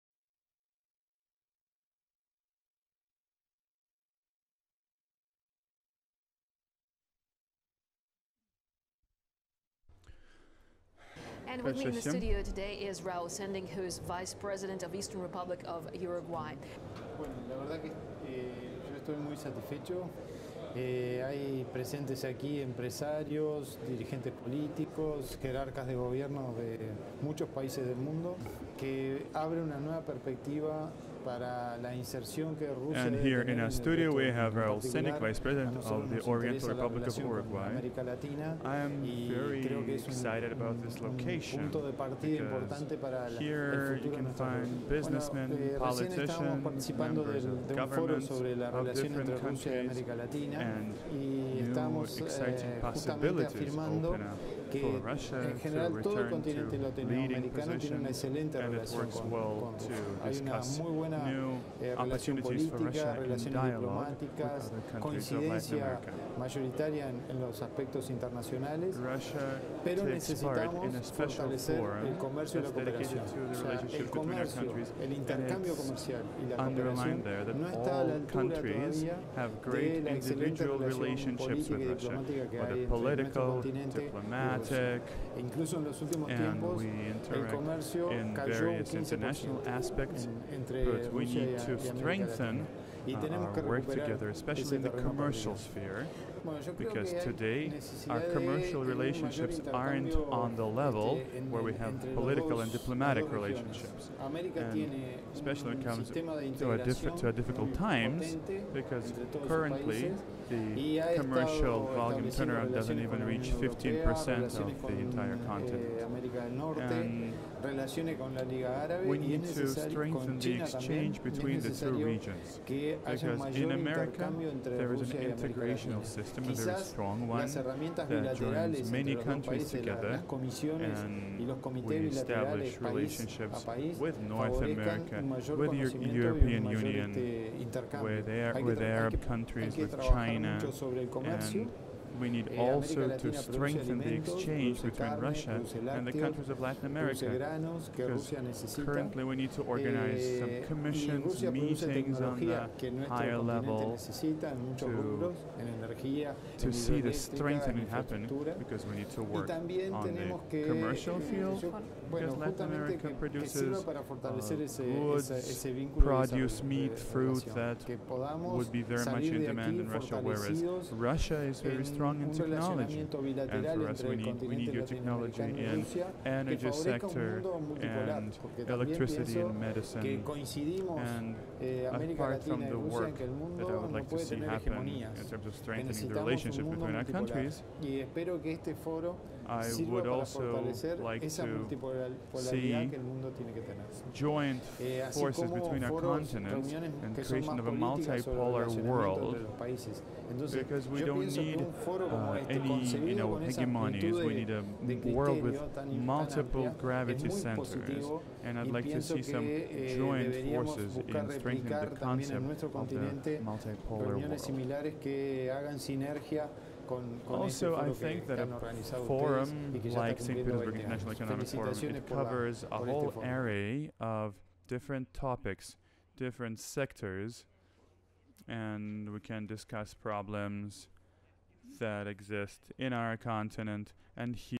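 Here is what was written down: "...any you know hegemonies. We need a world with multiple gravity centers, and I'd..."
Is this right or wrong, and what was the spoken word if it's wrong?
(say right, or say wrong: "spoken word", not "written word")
right.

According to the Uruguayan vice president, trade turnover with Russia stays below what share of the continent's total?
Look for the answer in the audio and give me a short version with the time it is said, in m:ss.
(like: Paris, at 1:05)
15%, at 1:53.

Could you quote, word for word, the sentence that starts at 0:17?
Bueno, la verdad que eh, yo estoy muy satisfecho.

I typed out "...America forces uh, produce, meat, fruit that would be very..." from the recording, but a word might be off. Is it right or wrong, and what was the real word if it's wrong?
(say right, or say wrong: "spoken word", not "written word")
wrong: "produces", not "forces".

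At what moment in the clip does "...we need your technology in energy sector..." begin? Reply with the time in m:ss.
2:54.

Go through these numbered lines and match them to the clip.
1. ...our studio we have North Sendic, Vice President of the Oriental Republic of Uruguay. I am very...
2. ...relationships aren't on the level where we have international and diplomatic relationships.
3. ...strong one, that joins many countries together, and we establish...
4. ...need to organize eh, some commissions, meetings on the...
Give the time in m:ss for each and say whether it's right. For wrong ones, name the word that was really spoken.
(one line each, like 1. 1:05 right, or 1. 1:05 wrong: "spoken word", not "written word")
1. 0:33 wrong: "Raul", not "North"
2. 1:38 wrong: "political", not "international"
3. 2:06 right
4. 2:29 right.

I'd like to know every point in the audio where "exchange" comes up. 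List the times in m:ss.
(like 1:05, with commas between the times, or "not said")
2:00, 2:24.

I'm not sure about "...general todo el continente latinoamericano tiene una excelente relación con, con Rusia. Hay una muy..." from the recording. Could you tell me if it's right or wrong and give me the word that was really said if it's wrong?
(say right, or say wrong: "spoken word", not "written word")
right.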